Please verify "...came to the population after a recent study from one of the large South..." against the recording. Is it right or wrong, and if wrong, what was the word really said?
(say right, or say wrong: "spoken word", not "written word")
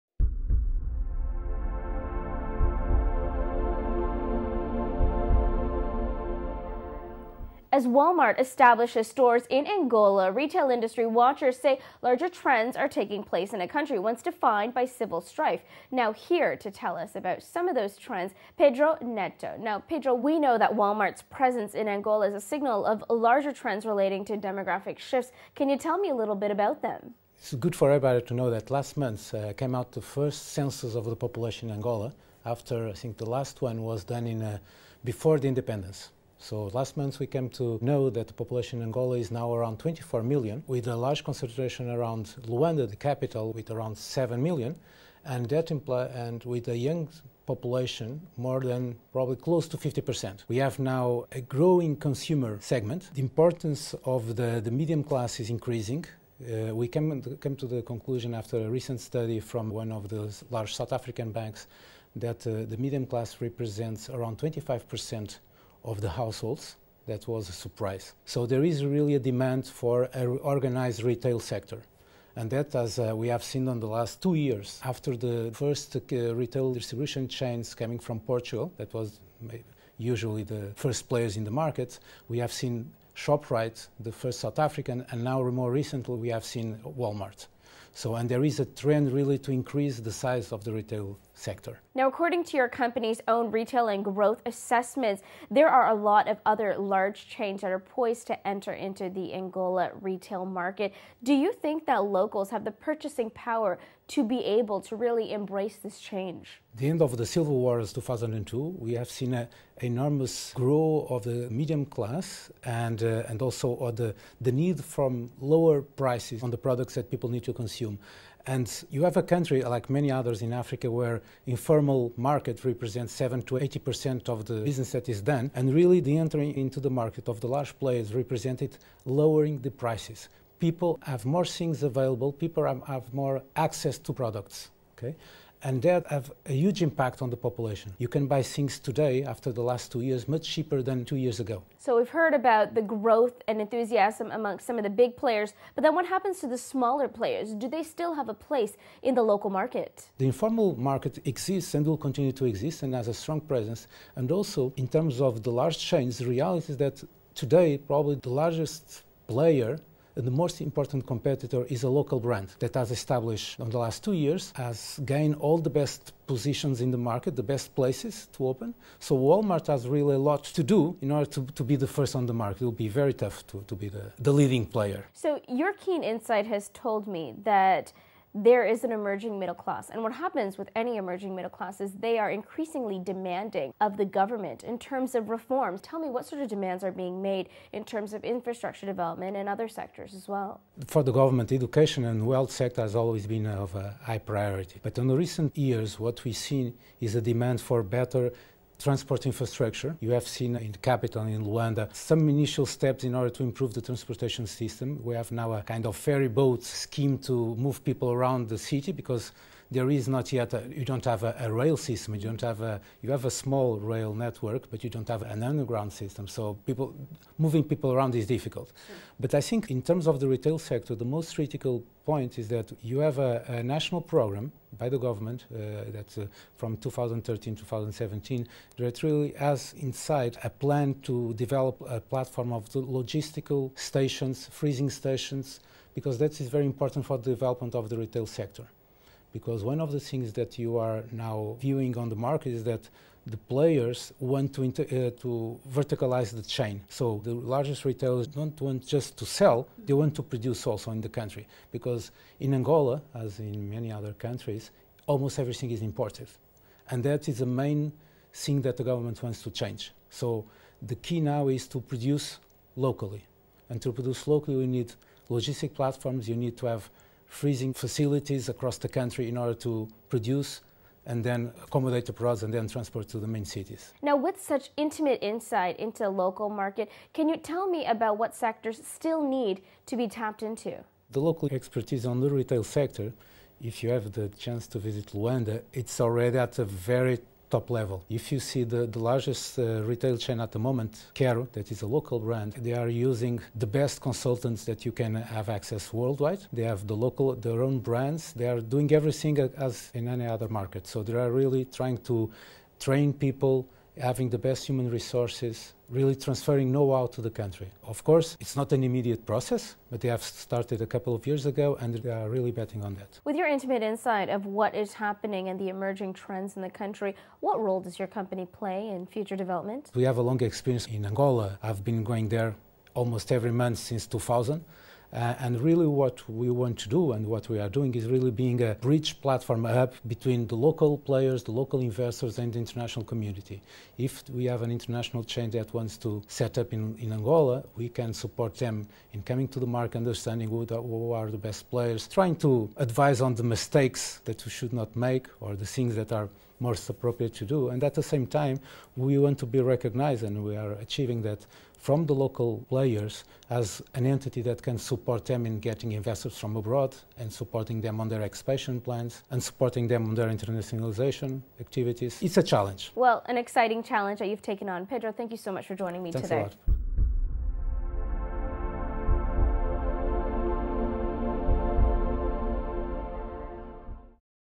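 wrong: "conclusion", not "population".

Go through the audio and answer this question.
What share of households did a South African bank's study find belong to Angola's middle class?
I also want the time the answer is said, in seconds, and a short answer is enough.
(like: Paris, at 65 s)
25%, at 64 s.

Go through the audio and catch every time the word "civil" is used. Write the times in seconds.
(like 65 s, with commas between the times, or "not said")
14 s, 107 s.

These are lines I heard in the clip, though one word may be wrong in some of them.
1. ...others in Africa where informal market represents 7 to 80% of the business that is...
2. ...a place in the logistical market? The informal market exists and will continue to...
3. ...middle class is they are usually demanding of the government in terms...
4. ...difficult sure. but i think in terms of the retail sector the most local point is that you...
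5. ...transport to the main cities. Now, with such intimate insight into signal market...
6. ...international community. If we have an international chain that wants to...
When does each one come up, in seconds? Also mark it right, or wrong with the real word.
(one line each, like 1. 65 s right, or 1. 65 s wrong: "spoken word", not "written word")
1. 120 s right
2. 148 s wrong: "local", not "logistical"
3. 181 s wrong: "increasingly", not "usually"
4. 218 s wrong: "critical", not "local"
5. 272 s wrong: "local", not "signal"
6. 332 s right.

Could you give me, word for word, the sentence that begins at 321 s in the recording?
I've been going there almost every month since 2000.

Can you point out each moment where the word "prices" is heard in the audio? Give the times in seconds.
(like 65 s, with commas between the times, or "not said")
115 s, 129 s.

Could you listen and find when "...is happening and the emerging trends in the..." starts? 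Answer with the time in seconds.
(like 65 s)
314 s.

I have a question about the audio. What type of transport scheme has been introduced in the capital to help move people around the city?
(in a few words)
ferry boat.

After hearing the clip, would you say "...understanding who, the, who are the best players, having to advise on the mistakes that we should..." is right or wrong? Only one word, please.
wrong.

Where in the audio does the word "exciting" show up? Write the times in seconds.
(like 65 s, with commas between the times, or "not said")
363 s.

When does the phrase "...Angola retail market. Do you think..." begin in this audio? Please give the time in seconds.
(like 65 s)
99 s.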